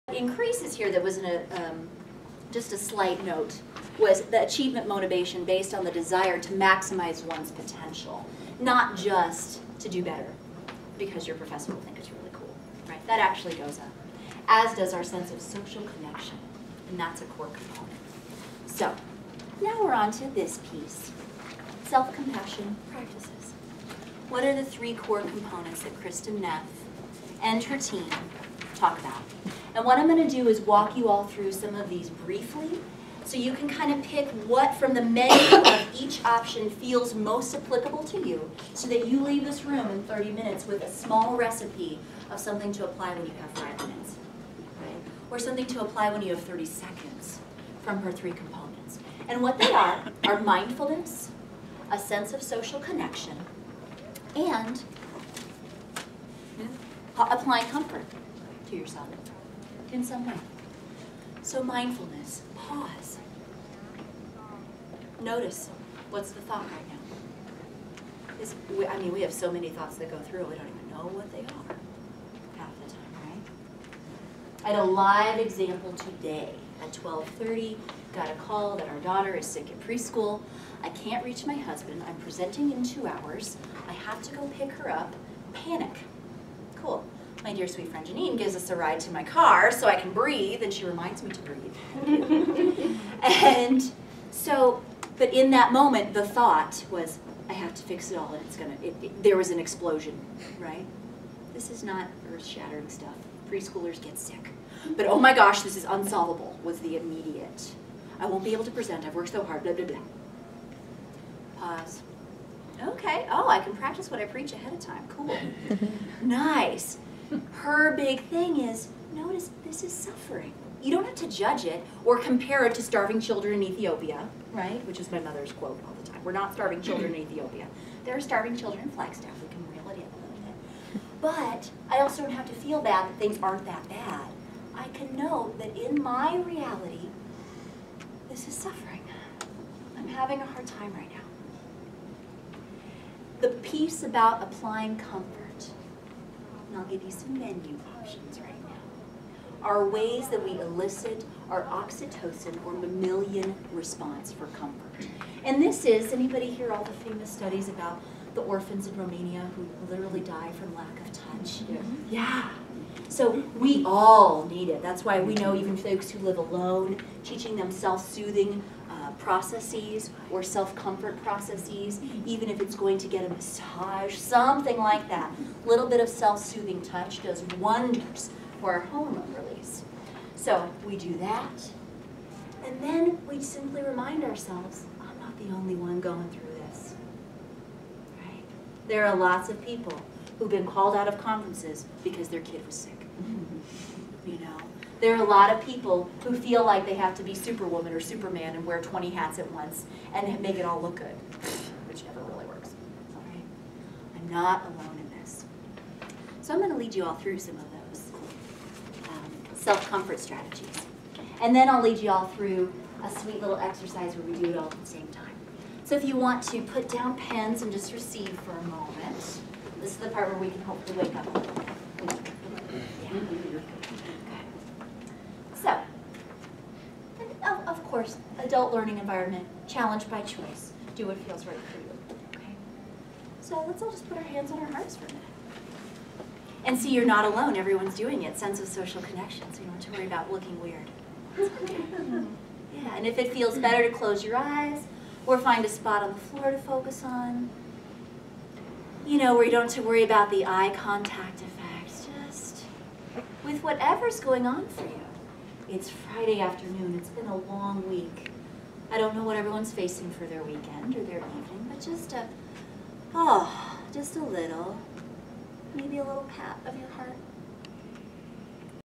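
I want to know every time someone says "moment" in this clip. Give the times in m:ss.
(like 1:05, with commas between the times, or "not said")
1:35, 3:38.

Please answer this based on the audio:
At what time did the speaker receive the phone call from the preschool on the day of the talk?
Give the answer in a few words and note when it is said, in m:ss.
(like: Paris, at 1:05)
12:30, at 1:16.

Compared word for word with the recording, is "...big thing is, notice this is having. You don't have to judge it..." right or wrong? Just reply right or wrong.
wrong.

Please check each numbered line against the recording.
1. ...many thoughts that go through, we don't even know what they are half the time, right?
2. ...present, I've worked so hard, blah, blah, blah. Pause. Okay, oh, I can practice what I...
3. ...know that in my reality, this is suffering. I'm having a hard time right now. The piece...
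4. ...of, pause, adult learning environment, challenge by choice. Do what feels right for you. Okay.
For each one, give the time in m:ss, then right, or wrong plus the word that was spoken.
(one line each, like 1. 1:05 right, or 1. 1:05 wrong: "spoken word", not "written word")
1. 1:09 right
2. 1:48 right
3. 2:15 right
4. 3:47 wrong: "course", not "pause".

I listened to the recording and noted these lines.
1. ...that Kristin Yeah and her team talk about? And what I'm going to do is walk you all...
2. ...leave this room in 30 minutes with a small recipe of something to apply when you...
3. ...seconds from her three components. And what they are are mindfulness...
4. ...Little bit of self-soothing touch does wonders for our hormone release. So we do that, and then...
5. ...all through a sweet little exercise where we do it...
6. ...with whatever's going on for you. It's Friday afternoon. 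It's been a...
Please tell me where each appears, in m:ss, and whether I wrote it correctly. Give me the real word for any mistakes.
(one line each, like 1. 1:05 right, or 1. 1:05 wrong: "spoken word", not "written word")
1. 0:25 wrong: "Neff", not "Yeah"
2. 0:39 right
3. 0:46 right
4. 2:55 right
5. 3:32 right
6. 4:13 right.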